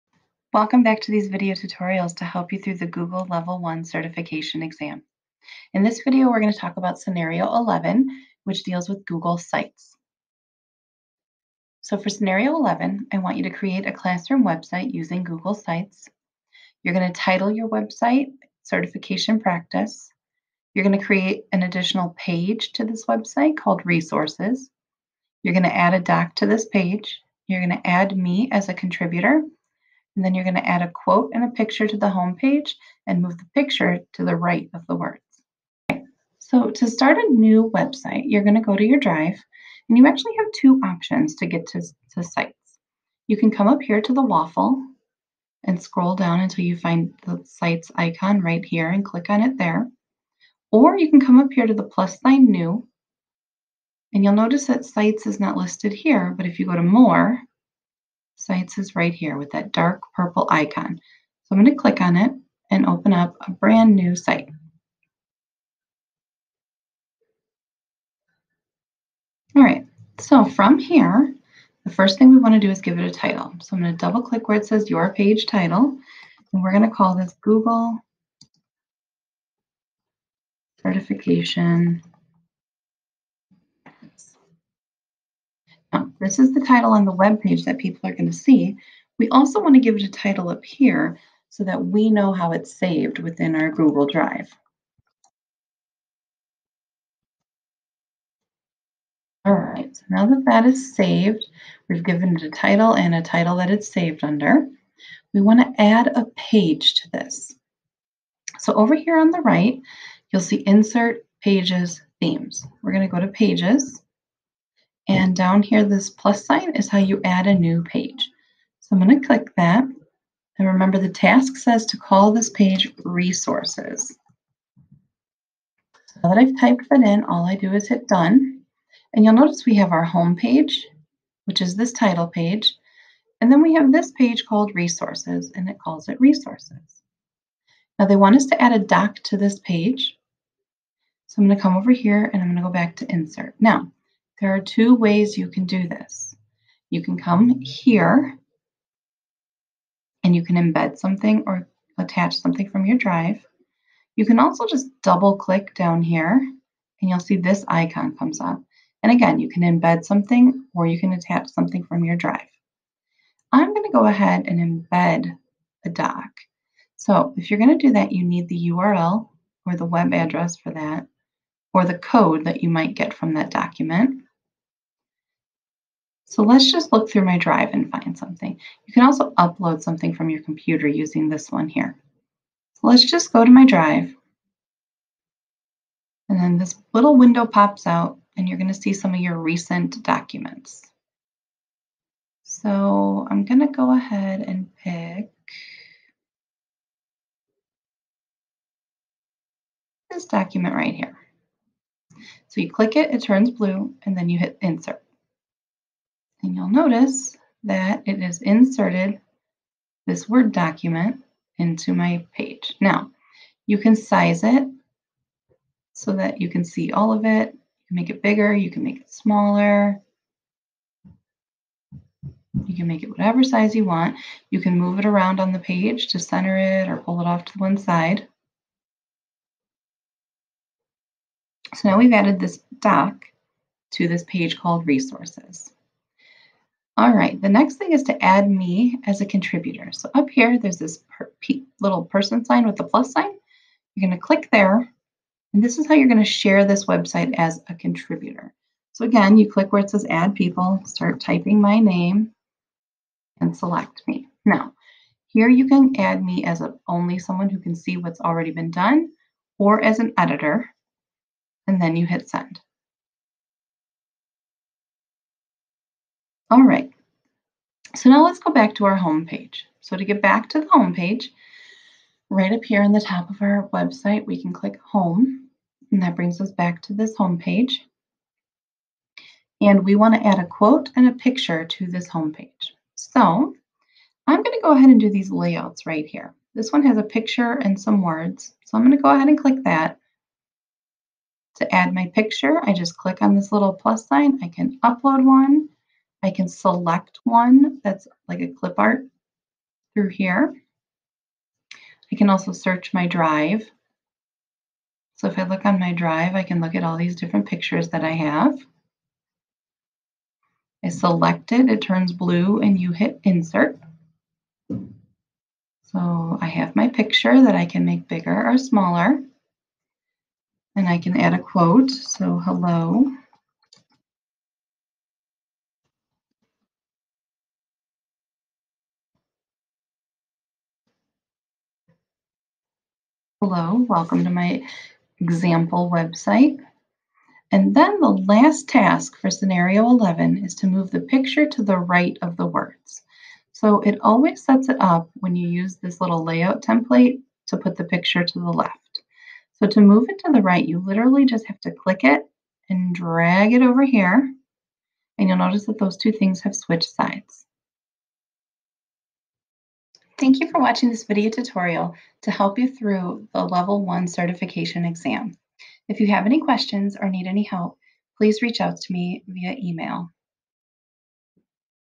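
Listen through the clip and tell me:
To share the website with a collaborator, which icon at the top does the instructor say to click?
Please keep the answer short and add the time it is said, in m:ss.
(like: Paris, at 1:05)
Little person sign, at 4:01.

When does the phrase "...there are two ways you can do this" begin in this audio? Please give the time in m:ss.
2:24.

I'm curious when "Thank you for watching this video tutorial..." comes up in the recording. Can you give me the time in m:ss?
6:00.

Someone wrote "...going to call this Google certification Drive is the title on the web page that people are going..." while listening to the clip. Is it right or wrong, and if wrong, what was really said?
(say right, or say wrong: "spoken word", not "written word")
wrong: "This", not "Drive".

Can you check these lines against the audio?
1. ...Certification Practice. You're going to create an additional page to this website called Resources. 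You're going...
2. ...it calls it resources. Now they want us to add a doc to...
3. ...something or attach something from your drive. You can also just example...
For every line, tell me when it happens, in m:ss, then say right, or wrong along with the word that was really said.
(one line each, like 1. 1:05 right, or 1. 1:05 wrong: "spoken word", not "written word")
1. 0:18 right
2. 2:15 right
3. 2:30 wrong: "double", not "example".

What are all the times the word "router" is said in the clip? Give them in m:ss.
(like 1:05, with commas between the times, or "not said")
not said.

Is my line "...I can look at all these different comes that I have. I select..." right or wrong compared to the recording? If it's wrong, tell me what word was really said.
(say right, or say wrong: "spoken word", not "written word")
wrong: "pictures", not "comes".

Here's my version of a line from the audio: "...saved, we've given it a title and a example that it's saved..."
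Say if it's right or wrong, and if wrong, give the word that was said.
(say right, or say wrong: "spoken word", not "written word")
wrong: "title", not "example".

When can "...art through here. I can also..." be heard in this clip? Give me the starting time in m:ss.
4:58.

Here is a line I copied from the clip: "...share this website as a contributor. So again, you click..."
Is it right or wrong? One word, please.
right.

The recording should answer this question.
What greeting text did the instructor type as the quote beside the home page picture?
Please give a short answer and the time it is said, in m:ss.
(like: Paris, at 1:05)
Welcome to my example website, at 5:33.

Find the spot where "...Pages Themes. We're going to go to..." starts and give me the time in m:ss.
1:51.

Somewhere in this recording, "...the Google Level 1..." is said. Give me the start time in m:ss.
0:02.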